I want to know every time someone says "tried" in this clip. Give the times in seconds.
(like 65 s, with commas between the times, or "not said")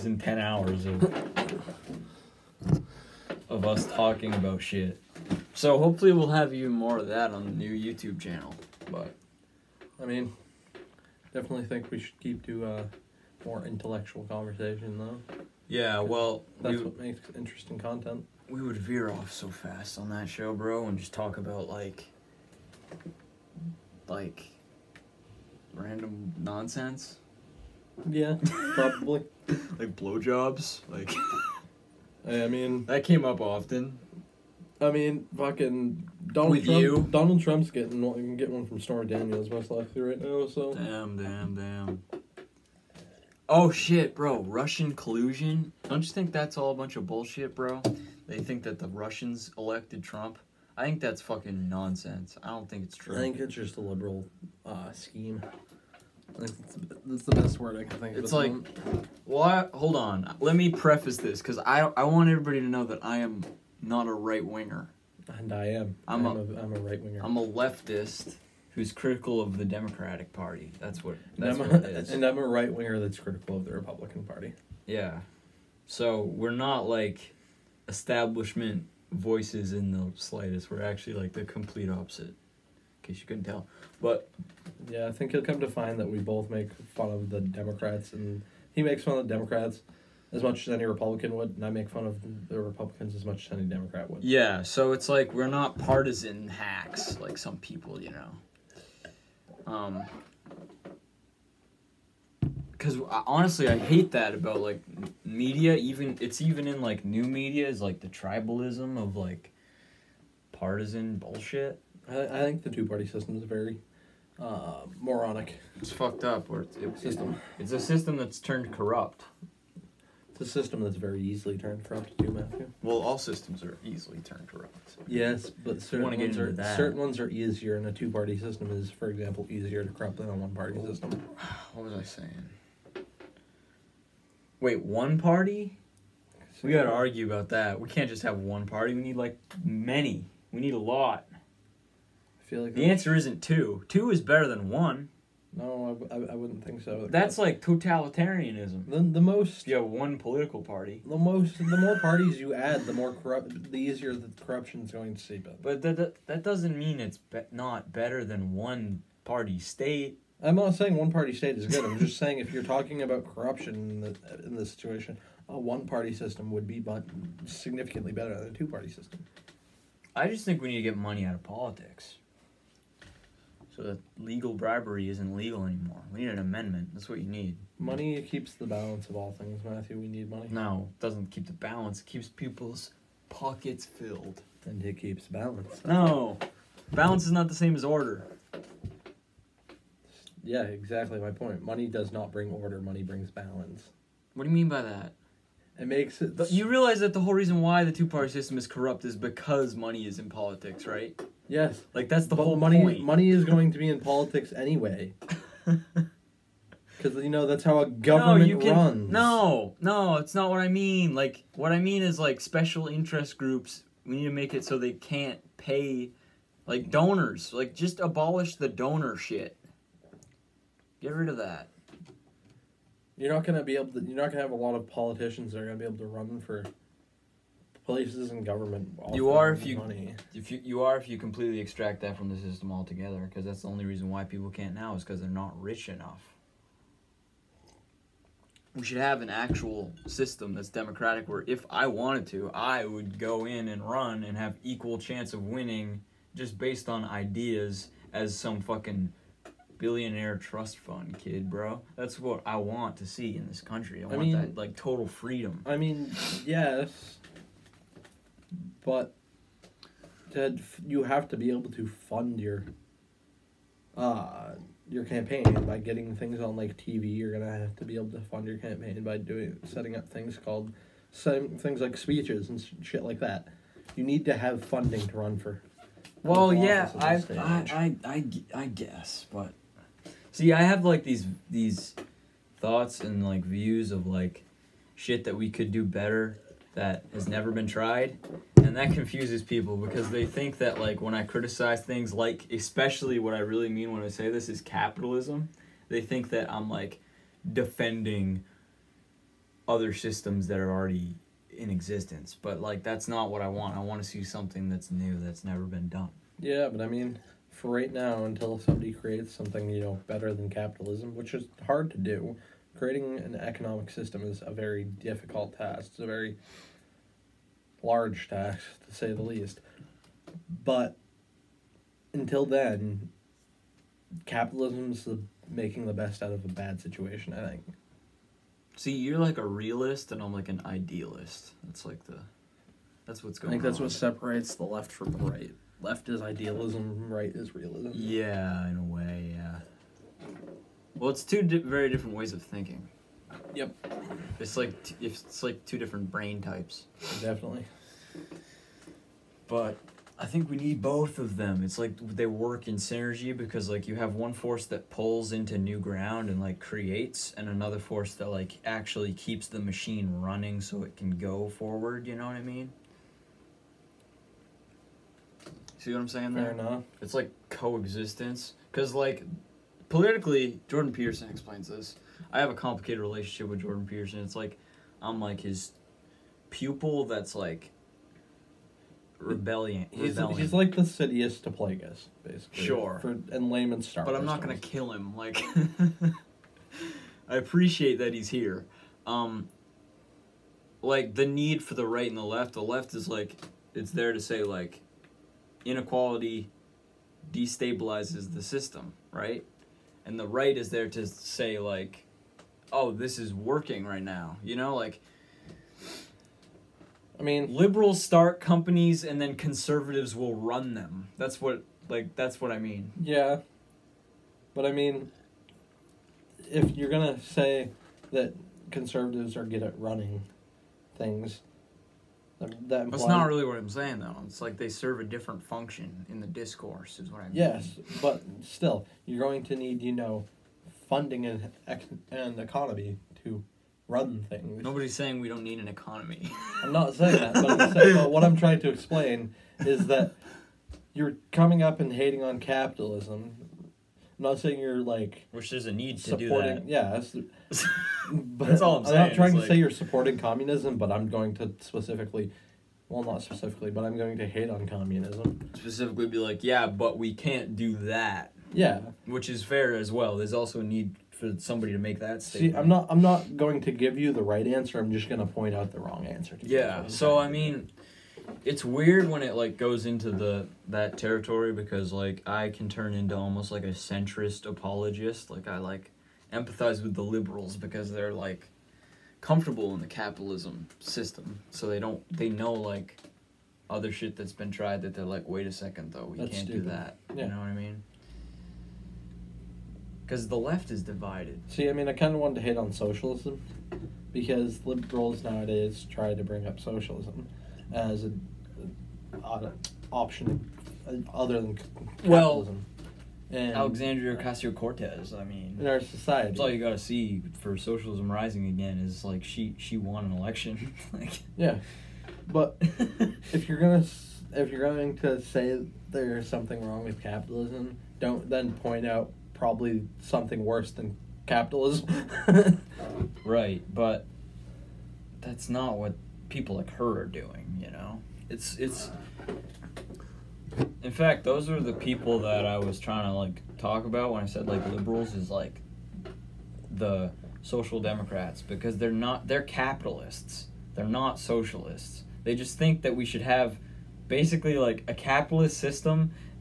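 287 s, 484 s.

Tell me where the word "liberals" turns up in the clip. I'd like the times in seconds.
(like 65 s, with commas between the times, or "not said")
53 s, 407 s, 477 s, 494 s, 534 s.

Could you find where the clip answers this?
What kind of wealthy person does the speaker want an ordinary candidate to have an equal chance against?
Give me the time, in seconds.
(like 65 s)
249 s.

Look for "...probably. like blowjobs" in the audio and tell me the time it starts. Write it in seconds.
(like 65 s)
28 s.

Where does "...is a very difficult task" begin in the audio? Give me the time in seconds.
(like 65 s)
314 s.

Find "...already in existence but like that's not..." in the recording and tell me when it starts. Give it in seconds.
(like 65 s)
300 s.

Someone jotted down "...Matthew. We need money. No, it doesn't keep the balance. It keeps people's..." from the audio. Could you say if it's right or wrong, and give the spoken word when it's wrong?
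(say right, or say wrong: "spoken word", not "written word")
right.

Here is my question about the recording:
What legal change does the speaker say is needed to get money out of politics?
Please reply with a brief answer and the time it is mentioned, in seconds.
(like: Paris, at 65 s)
An amendment, at 176 s.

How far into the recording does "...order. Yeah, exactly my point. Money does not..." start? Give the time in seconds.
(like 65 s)
187 s.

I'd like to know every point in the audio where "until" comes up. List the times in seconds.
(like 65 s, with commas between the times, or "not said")
308 s, 322 s.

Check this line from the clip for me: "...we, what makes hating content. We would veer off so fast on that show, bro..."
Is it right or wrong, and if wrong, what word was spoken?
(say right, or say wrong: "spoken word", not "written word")
wrong: "interesting", not "hating".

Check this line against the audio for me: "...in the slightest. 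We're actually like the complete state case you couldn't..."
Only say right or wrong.
wrong.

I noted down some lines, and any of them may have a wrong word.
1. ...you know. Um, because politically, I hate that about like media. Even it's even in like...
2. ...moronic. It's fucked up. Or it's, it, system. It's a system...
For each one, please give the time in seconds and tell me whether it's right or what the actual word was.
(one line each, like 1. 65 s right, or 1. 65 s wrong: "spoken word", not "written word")
1. 97 s wrong: "honestly", not "politically"
2. 114 s right.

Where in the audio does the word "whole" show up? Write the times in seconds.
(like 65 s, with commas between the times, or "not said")
197 s, 202 s.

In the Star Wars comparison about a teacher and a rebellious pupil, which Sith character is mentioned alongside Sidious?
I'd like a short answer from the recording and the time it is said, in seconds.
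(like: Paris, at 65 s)
Plagueis, at 381 s.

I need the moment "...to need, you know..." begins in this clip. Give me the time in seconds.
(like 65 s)
429 s.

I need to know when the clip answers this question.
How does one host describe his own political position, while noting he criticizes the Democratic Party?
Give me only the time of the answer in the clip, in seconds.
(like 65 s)
67 s.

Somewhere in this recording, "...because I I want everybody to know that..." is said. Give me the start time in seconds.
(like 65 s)
61 s.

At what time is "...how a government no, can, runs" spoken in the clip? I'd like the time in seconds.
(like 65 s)
207 s.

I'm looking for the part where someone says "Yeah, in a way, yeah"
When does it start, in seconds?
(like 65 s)
337 s.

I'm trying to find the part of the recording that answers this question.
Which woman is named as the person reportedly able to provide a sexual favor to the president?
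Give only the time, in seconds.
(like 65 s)
38 s.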